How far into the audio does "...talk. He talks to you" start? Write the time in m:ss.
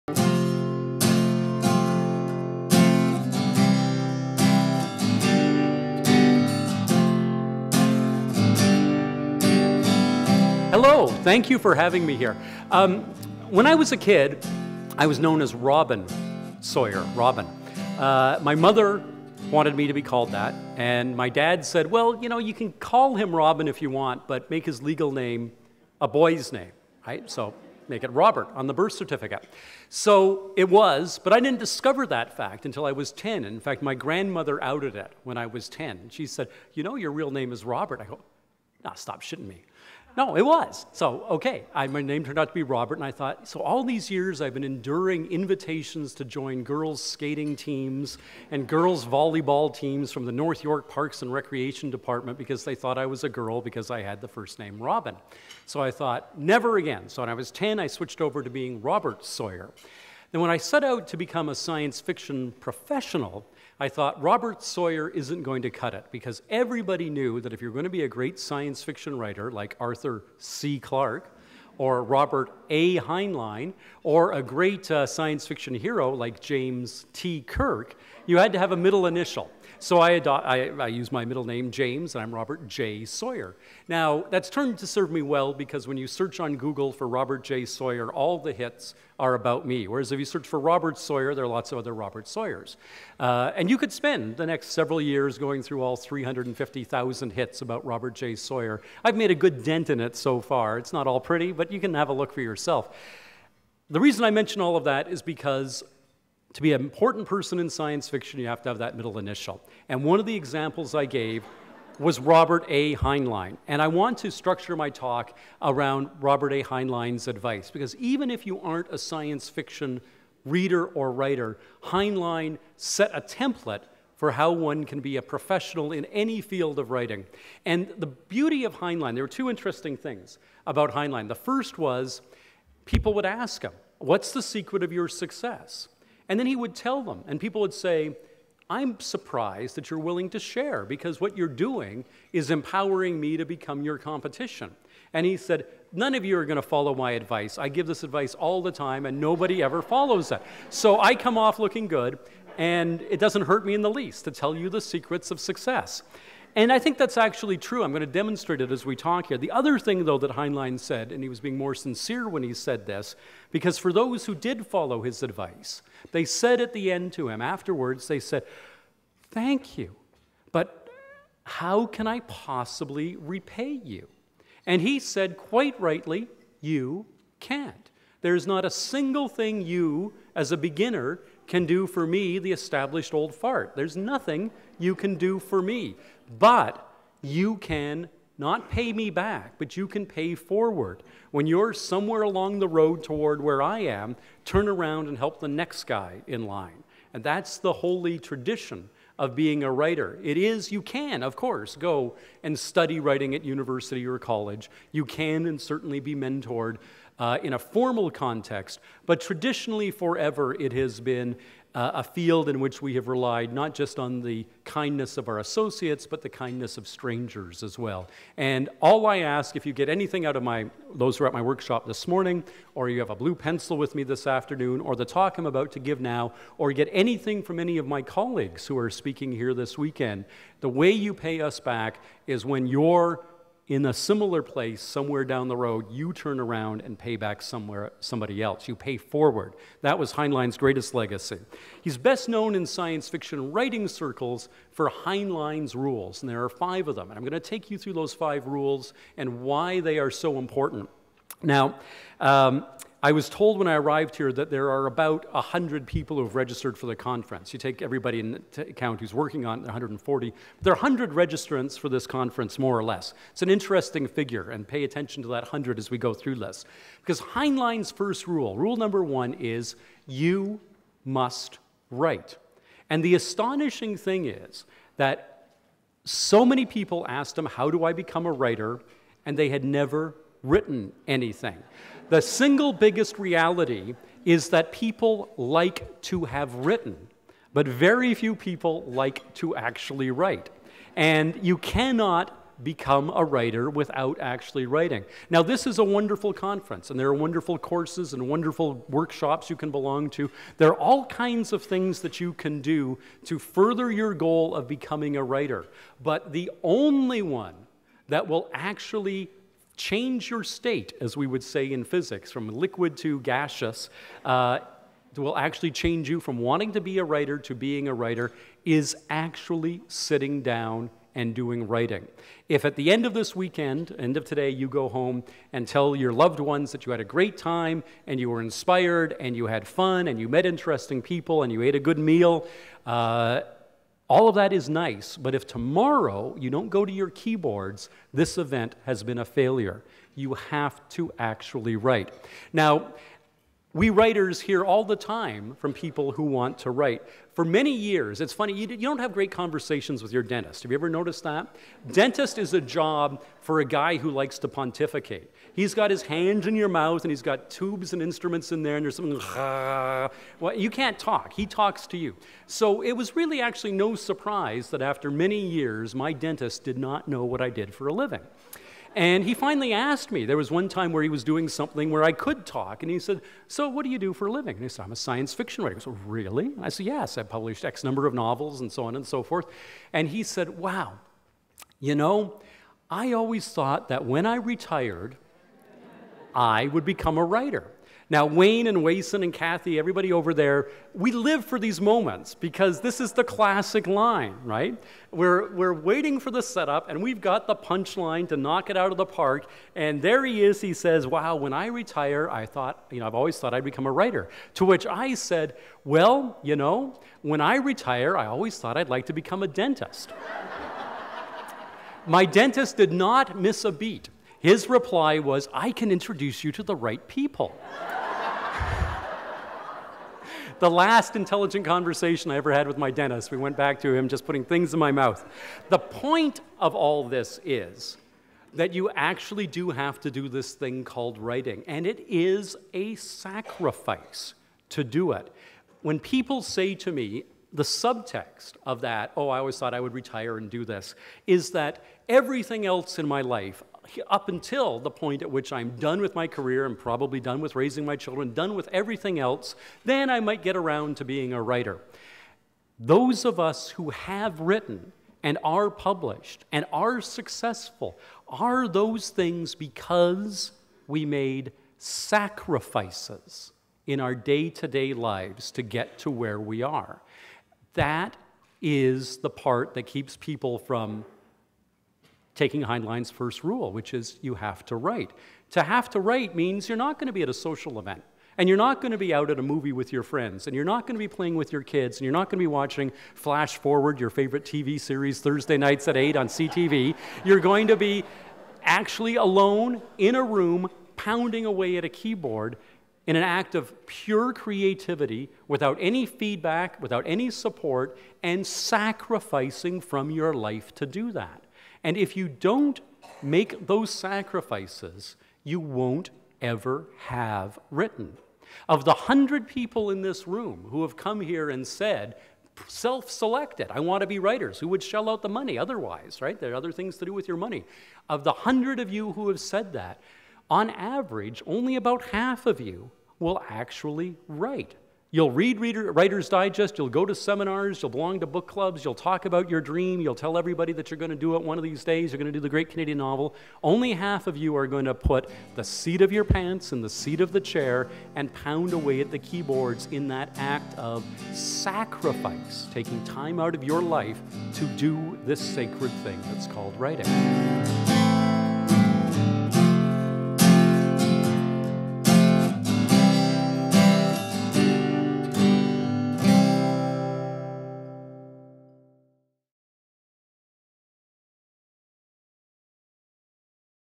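6:00.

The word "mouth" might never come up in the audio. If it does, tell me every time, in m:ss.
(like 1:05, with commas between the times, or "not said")
5:56, 7:04.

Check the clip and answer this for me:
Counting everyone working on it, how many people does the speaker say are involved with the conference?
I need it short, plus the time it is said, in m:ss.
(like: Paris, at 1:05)
140, at 4:19.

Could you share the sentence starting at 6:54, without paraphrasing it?
His reply was, I can introduce you to the right people.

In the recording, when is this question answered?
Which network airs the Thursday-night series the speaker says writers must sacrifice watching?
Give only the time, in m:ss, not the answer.
8:06.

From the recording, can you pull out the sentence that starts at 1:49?
And one of the examples I gave was Robert A.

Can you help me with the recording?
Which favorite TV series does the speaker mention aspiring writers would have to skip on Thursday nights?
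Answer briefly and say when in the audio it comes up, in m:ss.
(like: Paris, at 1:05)
Flash Forward, at 8:03.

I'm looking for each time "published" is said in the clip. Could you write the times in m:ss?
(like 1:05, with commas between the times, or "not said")
6:17, 7:35.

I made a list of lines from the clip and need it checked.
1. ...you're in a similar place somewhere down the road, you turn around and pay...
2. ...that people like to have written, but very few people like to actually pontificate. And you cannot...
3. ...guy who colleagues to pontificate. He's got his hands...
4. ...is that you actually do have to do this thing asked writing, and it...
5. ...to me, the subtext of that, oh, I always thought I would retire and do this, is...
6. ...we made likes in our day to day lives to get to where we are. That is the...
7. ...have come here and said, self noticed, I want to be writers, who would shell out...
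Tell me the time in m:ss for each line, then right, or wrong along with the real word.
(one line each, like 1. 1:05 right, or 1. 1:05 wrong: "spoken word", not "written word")
1. 3:52 right
2. 4:44 wrong: "write", not "pontificate"
3. 5:53 wrong: "likes", not "colleagues"
4. 7:07 wrong: "called", not "asked"
5. 7:16 right
6. 7:40 wrong: "sacrifices", not "likes"
7. 8:30 wrong: "selected", not "noticed".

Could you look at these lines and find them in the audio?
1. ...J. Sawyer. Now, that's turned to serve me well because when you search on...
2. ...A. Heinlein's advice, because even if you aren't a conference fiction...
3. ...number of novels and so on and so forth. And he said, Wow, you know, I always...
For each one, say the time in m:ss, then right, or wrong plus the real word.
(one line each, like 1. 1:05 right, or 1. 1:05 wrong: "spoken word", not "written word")
1. 1:22 right
2. 1:56 wrong: "science", not "conference"
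3. 6:17 right.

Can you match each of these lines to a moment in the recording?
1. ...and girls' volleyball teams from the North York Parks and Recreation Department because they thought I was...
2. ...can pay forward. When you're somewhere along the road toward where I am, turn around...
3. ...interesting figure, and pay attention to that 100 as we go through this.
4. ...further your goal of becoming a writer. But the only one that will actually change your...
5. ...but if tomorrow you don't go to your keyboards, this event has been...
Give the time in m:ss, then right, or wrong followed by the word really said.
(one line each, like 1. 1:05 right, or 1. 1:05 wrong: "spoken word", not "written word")
1. 0:48 right
2. 3:09 right
3. 4:23 right
4. 5:03 right
5. 5:35 right.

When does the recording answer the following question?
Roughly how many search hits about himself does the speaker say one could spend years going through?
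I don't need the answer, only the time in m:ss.
1:35.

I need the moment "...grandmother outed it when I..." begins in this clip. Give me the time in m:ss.
0:33.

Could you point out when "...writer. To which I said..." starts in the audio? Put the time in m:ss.
6:43.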